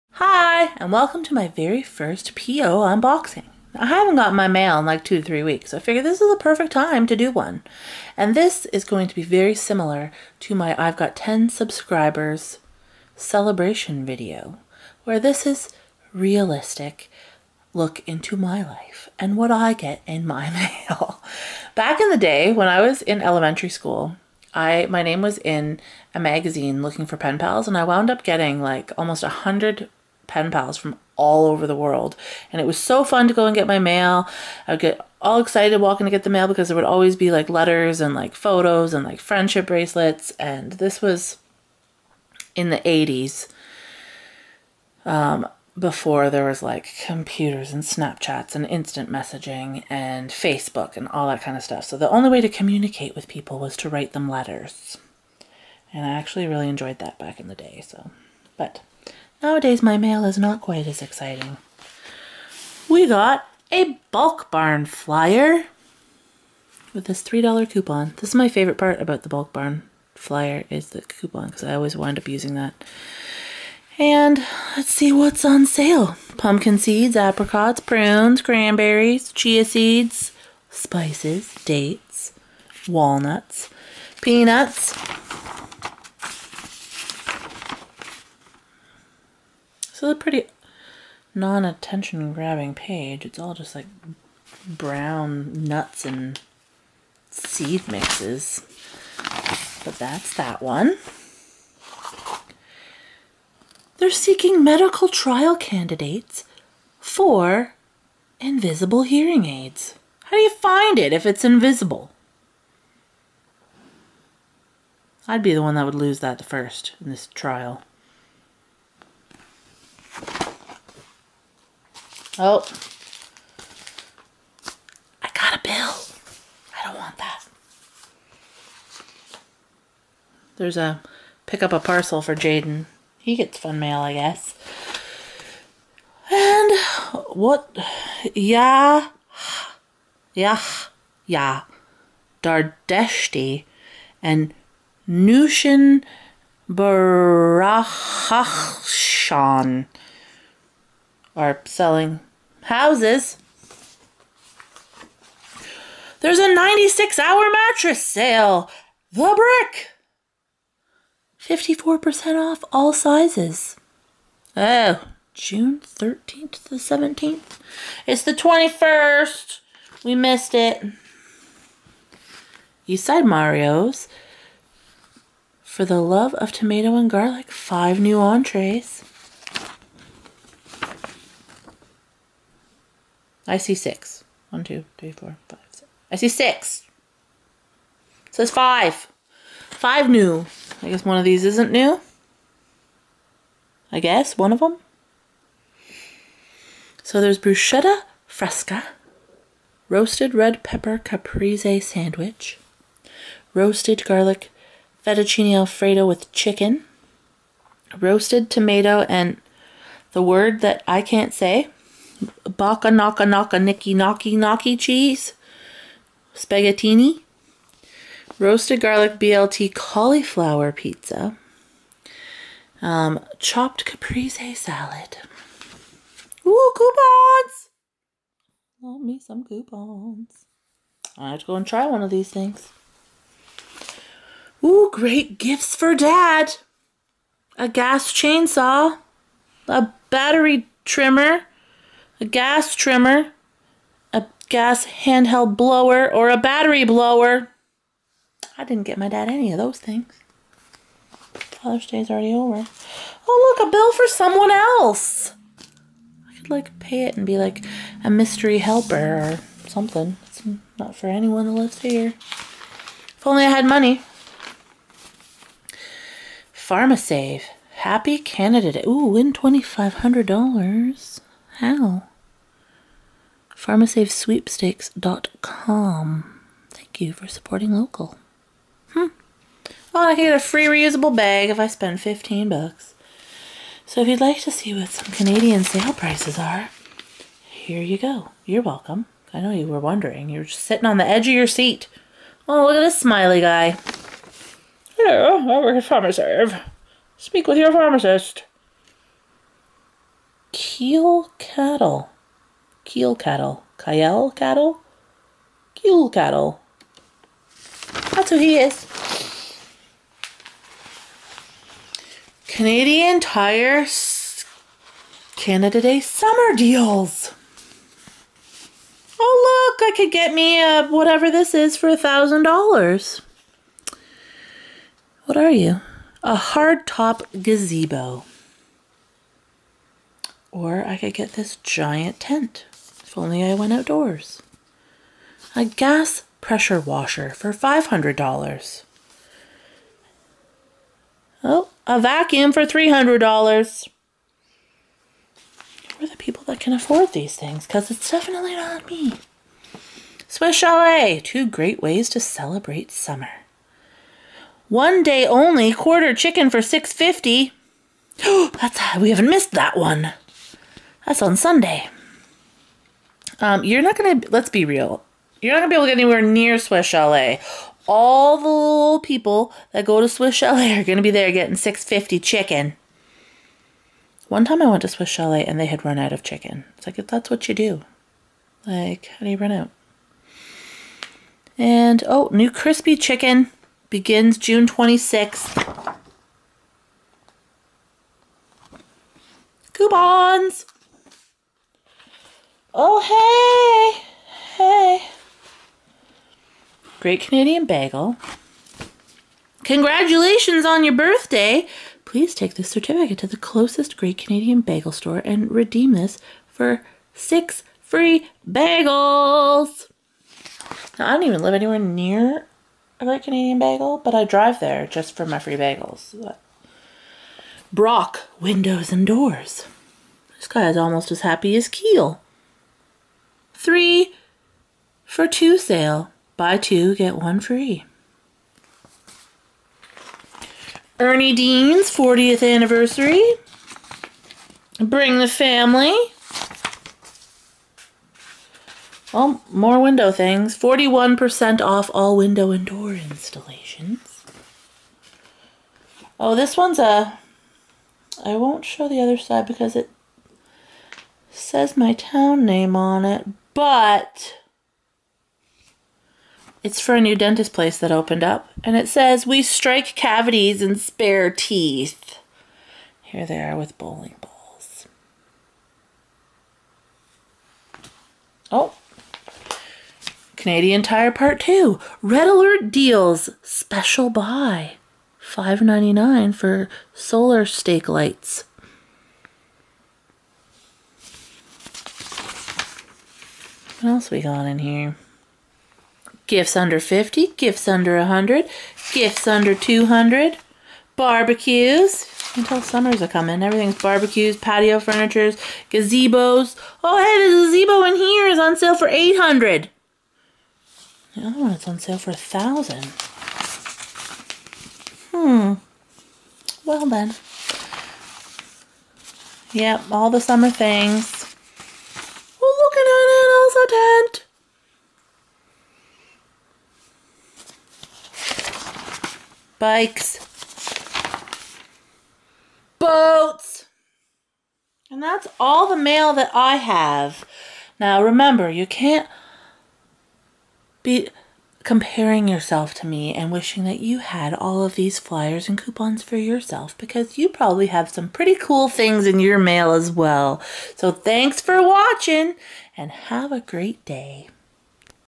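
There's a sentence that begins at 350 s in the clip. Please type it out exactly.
Swiss Chalet, two great ways to celebrate summer.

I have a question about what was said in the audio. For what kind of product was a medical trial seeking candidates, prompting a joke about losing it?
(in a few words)
invisible hearing aids.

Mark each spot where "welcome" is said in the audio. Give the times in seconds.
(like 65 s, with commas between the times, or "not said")
0 s, 288 s.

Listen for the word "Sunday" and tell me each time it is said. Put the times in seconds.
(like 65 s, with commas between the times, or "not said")
361 s.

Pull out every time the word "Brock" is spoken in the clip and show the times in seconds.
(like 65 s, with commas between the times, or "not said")
417 s.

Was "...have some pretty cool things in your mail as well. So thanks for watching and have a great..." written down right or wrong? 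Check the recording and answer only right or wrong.
right.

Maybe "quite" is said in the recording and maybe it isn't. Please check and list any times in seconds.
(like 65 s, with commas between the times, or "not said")
60 s.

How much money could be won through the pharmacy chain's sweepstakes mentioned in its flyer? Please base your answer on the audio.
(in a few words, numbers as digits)
$2,500.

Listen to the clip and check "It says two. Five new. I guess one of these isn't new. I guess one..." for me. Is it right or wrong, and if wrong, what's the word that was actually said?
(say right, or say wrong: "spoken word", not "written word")
wrong: "five", not "two".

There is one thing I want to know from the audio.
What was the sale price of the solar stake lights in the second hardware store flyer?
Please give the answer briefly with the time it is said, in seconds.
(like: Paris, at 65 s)
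$5.99, at 475 s.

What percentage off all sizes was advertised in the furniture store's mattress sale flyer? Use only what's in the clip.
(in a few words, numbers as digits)
54%.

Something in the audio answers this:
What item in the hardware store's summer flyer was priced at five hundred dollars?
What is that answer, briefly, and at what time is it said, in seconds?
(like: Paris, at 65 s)
gas pressure washer, at 335 s.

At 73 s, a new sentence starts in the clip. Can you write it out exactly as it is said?
And let's see what's on sale.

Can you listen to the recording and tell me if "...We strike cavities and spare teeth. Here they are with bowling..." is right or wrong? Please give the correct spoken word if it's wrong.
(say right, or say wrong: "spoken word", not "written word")
right.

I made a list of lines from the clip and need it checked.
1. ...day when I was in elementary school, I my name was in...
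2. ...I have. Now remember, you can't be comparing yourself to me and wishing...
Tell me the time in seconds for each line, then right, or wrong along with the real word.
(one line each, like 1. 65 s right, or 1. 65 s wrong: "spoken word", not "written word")
1. 22 s right
2. 526 s right.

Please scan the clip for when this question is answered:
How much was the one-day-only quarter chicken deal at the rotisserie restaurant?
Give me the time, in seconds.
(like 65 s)
356 s.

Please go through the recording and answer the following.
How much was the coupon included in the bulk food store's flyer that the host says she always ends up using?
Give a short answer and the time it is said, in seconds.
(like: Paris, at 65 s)
$3, at 67 s.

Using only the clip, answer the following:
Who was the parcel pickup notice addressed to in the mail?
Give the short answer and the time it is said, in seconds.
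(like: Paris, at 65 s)
Jaden, at 132 s.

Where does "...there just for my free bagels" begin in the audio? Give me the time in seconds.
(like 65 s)
414 s.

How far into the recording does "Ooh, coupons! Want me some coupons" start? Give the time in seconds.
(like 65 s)
226 s.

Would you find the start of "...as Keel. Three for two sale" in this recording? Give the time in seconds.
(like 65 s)
421 s.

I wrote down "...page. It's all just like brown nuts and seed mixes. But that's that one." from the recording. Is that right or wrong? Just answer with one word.
right.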